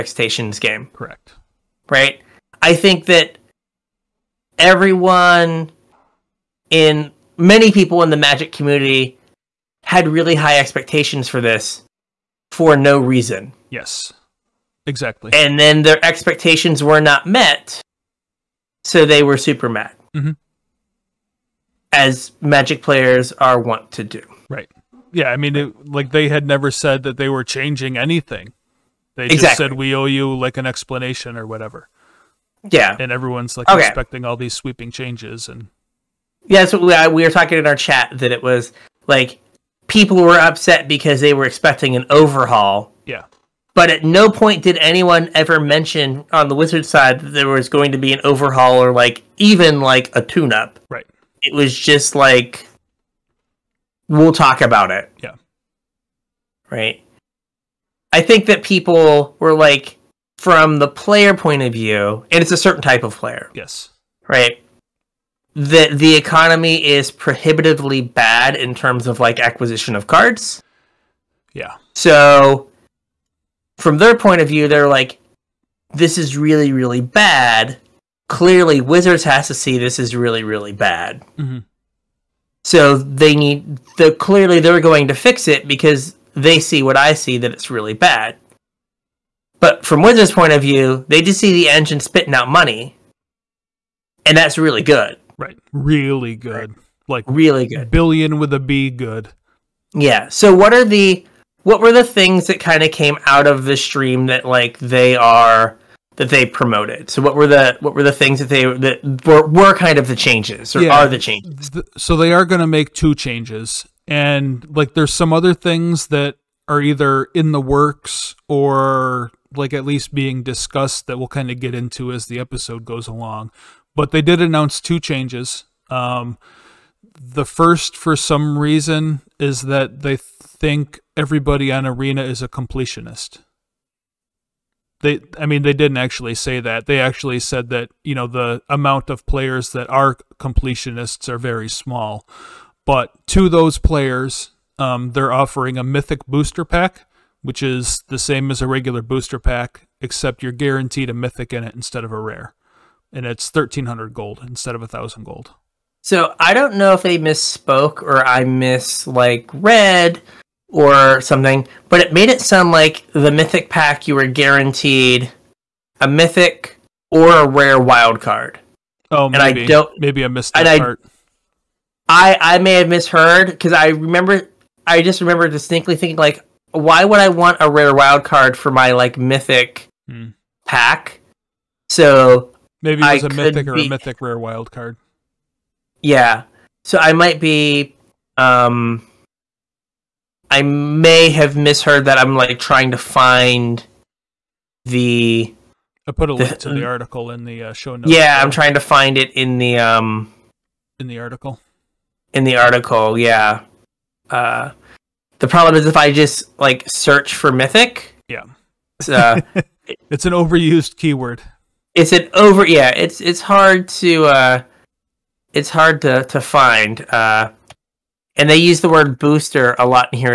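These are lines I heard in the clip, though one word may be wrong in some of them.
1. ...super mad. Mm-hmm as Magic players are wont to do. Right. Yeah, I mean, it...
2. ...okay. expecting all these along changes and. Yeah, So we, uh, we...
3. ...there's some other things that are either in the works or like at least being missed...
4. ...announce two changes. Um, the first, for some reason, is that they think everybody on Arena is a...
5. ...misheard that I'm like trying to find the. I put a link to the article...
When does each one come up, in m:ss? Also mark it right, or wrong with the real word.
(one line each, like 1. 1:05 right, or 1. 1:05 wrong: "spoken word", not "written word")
1. 0:19 right
2. 0:33 wrong: "sweeping", not "along"
3. 1:54 wrong: "discussed", not "missed"
4. 2:04 right
5. 3:11 right.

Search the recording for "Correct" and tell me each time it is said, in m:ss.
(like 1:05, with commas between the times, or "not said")
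0:00.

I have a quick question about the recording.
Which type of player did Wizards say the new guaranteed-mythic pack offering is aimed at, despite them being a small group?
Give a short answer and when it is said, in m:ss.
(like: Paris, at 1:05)
completionists, at 2:20.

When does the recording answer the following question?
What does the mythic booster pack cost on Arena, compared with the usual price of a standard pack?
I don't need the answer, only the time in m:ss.
2:33.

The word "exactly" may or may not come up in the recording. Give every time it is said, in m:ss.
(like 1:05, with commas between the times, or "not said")
0:14, 0:29.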